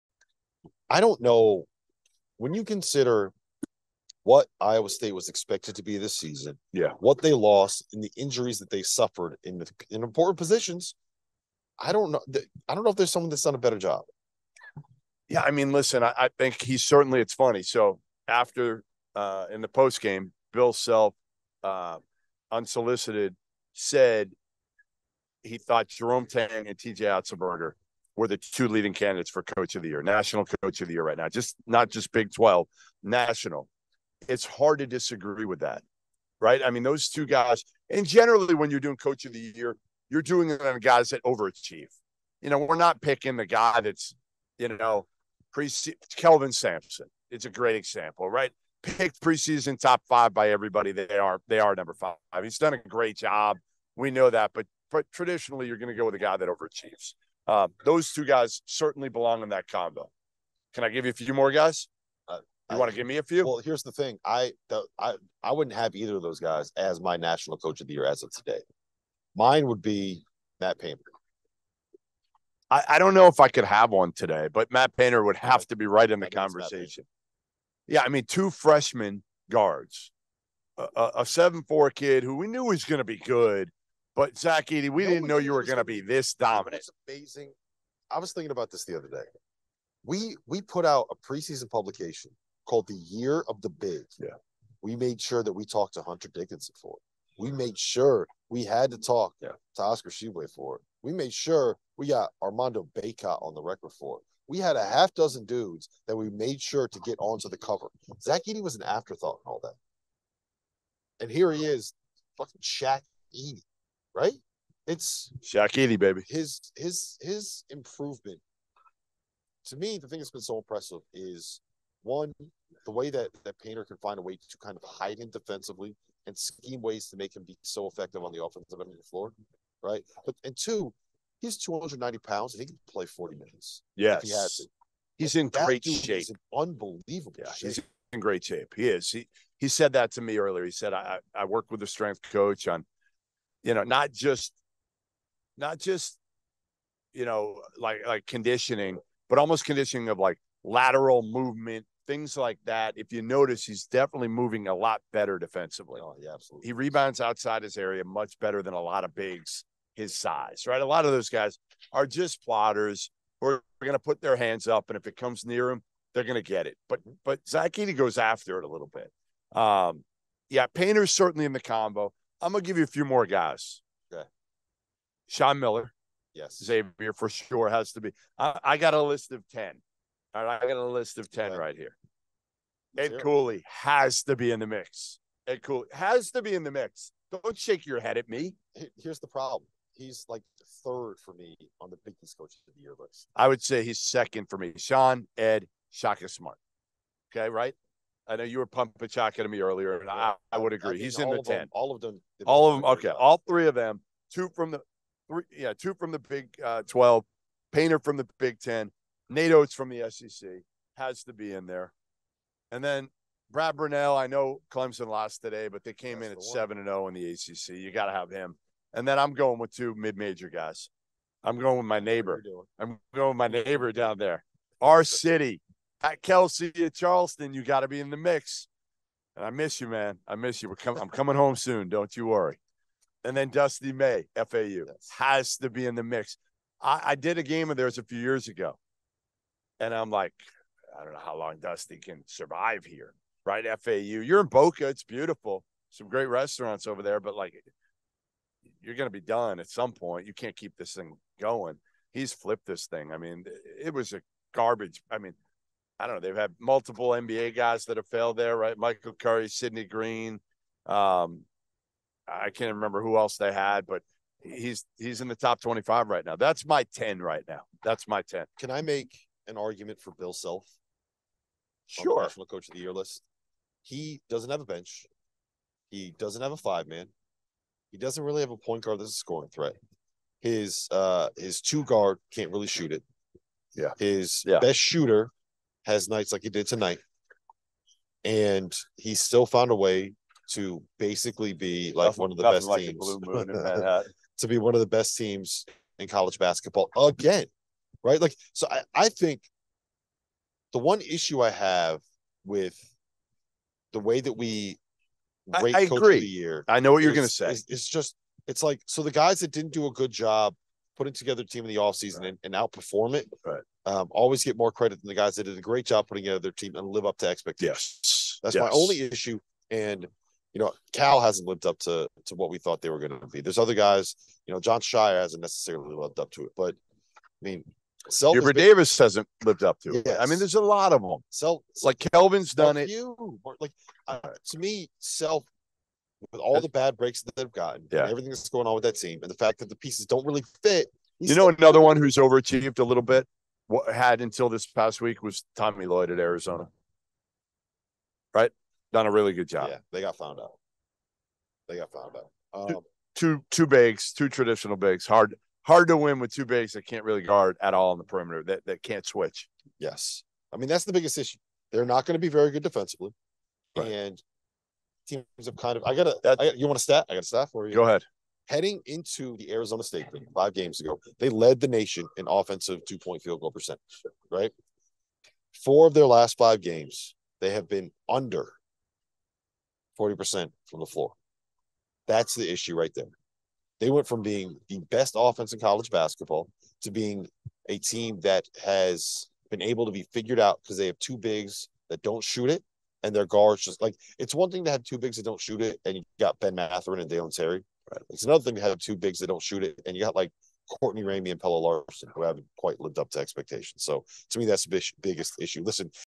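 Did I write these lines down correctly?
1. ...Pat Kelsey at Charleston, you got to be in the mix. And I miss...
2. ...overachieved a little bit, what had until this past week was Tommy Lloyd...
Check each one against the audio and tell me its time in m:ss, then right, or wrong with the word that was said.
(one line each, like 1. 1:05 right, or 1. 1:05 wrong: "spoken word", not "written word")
1. 3:46 right
2. 5:42 right.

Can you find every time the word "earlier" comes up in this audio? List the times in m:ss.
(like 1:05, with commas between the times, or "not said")
2:20, 3:19.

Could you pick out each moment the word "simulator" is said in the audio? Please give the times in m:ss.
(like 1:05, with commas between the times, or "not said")
not said.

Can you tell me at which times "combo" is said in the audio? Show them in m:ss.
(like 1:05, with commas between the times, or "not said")
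0:59, 2:51.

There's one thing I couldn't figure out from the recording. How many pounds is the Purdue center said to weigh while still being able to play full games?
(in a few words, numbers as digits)
290.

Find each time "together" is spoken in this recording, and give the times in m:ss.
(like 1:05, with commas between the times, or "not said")
5:11, 5:16.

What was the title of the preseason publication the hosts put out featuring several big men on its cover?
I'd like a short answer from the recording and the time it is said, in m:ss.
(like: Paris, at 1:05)
The Year of the Big, at 1:32.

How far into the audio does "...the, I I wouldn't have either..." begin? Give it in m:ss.
1:04.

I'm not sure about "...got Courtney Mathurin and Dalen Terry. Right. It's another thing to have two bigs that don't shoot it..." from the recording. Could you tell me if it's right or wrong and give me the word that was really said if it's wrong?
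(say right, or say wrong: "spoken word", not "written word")
wrong: "Ben", not "Courtney".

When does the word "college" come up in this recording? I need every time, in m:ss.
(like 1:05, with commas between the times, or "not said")
4:56, 6:25.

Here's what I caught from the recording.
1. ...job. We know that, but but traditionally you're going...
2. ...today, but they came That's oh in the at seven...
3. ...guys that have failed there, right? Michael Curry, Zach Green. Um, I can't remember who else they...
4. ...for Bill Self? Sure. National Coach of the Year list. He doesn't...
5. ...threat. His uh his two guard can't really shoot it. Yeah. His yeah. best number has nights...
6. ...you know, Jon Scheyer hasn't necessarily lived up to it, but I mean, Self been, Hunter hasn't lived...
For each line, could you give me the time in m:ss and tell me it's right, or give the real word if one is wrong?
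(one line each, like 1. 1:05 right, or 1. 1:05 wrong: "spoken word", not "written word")
1. 0:53 right
2. 3:35 right
3. 4:17 wrong: "Sidney", not "Zach"
4. 4:30 right
5. 4:39 wrong: "shooter", not "number"
6. 5:24 wrong: "Davis", not "Hunter".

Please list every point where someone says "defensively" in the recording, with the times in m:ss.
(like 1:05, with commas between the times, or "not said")
2:05, 2:35, 6:02.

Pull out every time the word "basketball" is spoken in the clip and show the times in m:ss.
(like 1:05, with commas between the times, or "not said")
4:56, 6:25.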